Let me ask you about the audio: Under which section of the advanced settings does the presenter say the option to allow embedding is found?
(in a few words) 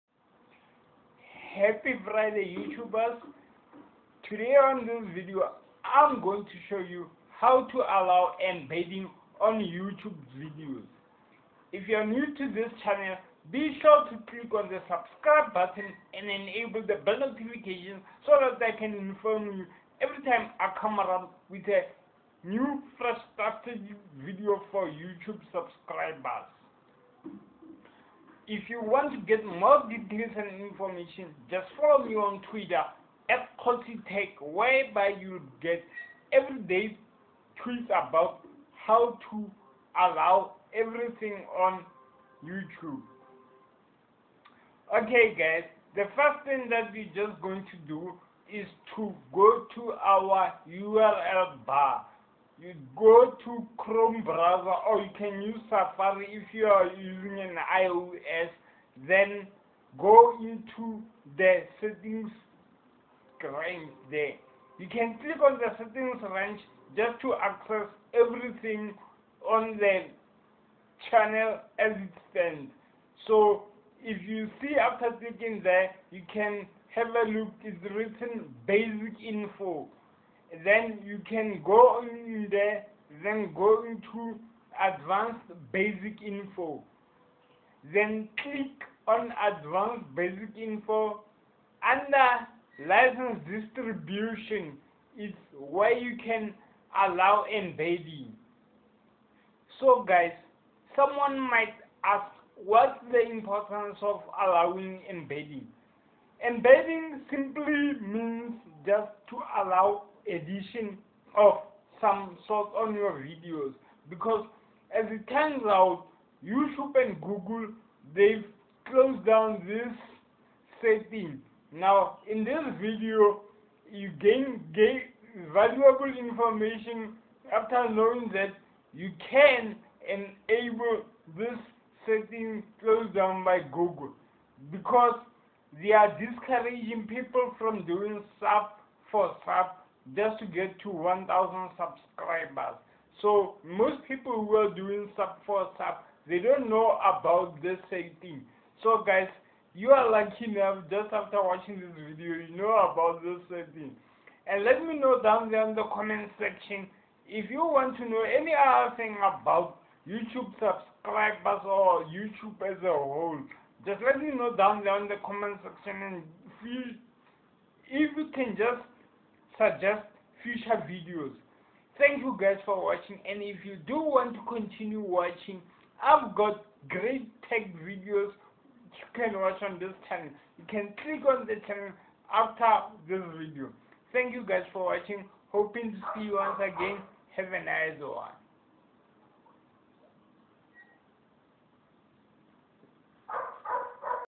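license distribution.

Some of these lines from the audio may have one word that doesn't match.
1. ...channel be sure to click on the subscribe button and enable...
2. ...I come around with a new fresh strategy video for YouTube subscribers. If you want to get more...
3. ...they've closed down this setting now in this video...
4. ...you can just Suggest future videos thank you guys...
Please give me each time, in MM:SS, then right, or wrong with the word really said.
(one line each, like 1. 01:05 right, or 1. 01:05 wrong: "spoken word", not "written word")
1. 00:12 right
2. 00:20 right
3. 01:58 right
4. 02:48 right.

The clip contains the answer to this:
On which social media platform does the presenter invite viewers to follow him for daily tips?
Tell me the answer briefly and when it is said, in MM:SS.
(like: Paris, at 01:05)
Twitter, at 00:32.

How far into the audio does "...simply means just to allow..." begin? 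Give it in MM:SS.
01:47.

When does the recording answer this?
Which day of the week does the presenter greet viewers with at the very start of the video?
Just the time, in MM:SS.
00:02.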